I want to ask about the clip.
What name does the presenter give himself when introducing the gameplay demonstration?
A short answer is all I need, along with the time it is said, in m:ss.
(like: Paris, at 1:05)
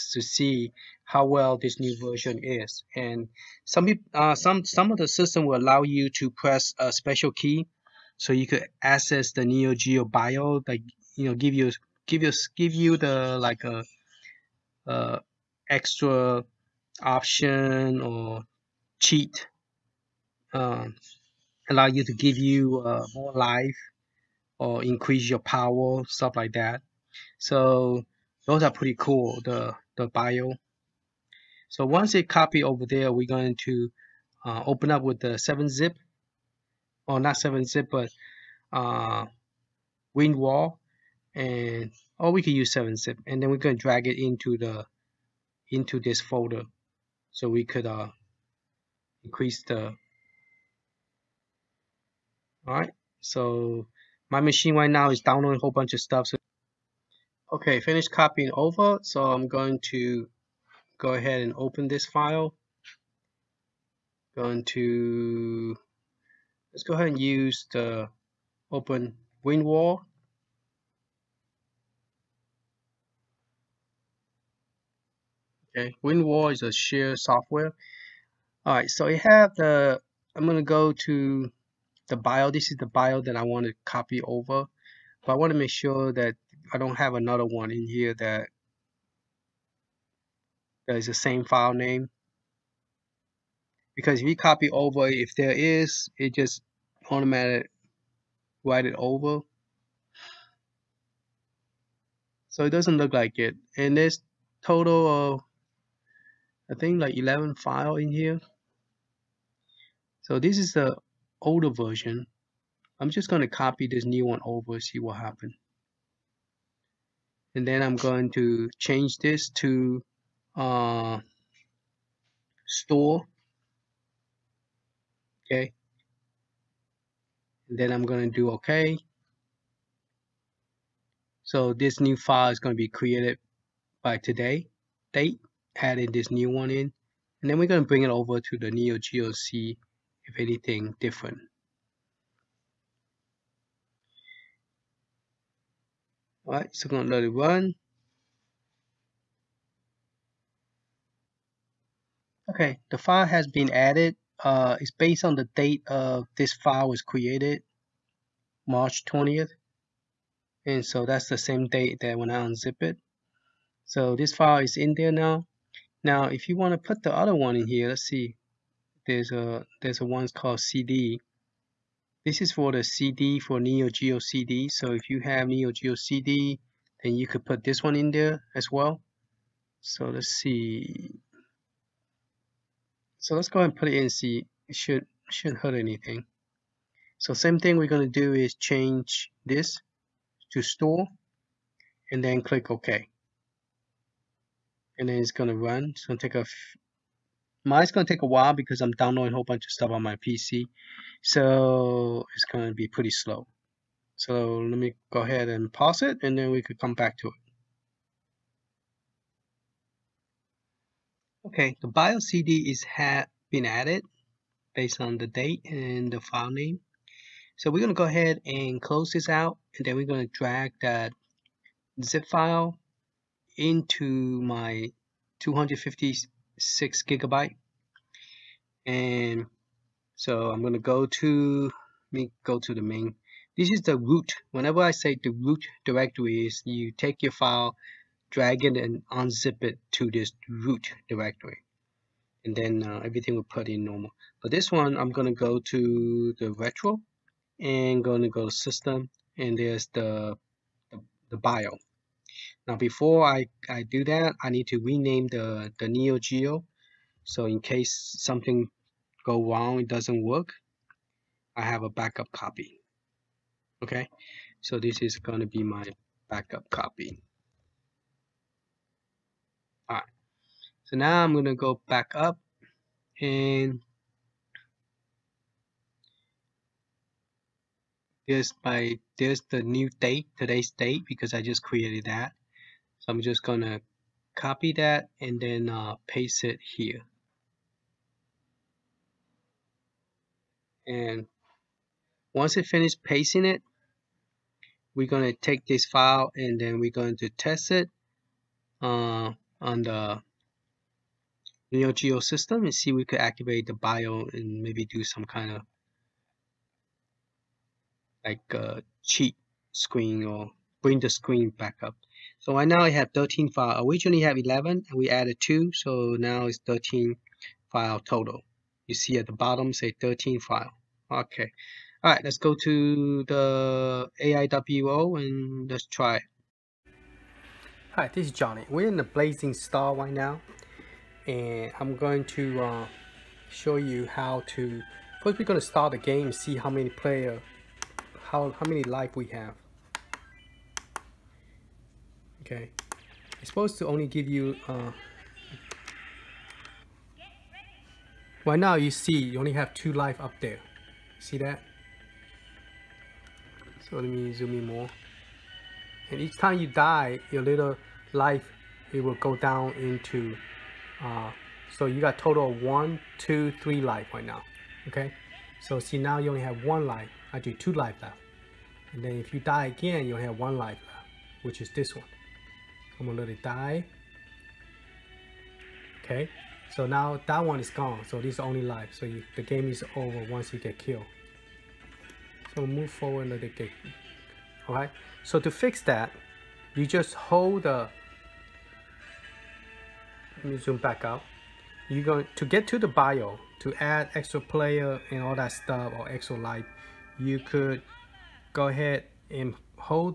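Johnny, at 5:28.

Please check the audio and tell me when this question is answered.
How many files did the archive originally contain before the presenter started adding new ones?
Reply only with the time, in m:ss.
5:13.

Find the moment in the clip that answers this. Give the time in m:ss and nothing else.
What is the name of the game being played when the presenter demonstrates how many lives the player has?
5:29.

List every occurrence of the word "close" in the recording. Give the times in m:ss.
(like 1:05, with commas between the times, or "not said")
3:38.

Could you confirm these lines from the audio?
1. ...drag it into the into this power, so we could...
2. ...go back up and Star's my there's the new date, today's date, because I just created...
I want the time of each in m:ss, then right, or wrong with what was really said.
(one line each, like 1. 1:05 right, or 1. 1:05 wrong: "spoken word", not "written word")
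1. 0:43 wrong: "folder", not "power"
2. 4:31 wrong: "There", not "Star".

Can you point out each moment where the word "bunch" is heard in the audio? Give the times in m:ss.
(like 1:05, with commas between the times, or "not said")
0:55, 3:19.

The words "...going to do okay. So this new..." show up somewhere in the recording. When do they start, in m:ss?
2:08.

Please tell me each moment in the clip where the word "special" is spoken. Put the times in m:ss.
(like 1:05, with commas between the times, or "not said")
0:06.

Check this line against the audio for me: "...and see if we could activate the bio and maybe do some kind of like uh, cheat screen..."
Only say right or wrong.
right.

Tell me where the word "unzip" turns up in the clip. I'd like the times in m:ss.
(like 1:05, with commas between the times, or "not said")
2:42, 3:59.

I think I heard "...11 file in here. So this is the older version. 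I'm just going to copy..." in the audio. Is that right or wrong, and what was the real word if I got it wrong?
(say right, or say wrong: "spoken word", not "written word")
right.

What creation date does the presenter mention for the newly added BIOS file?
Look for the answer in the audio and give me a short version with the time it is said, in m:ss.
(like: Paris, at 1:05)
March 20th, at 2:38.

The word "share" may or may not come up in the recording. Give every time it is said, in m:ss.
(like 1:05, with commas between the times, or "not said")
1:16.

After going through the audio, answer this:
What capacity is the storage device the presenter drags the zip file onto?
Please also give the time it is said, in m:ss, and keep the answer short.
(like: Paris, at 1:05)
256 gigabytes, at 3:45.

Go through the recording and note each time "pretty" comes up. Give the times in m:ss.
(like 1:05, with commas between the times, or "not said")
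0:28, 3:22.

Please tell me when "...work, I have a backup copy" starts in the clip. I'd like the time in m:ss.
4:20.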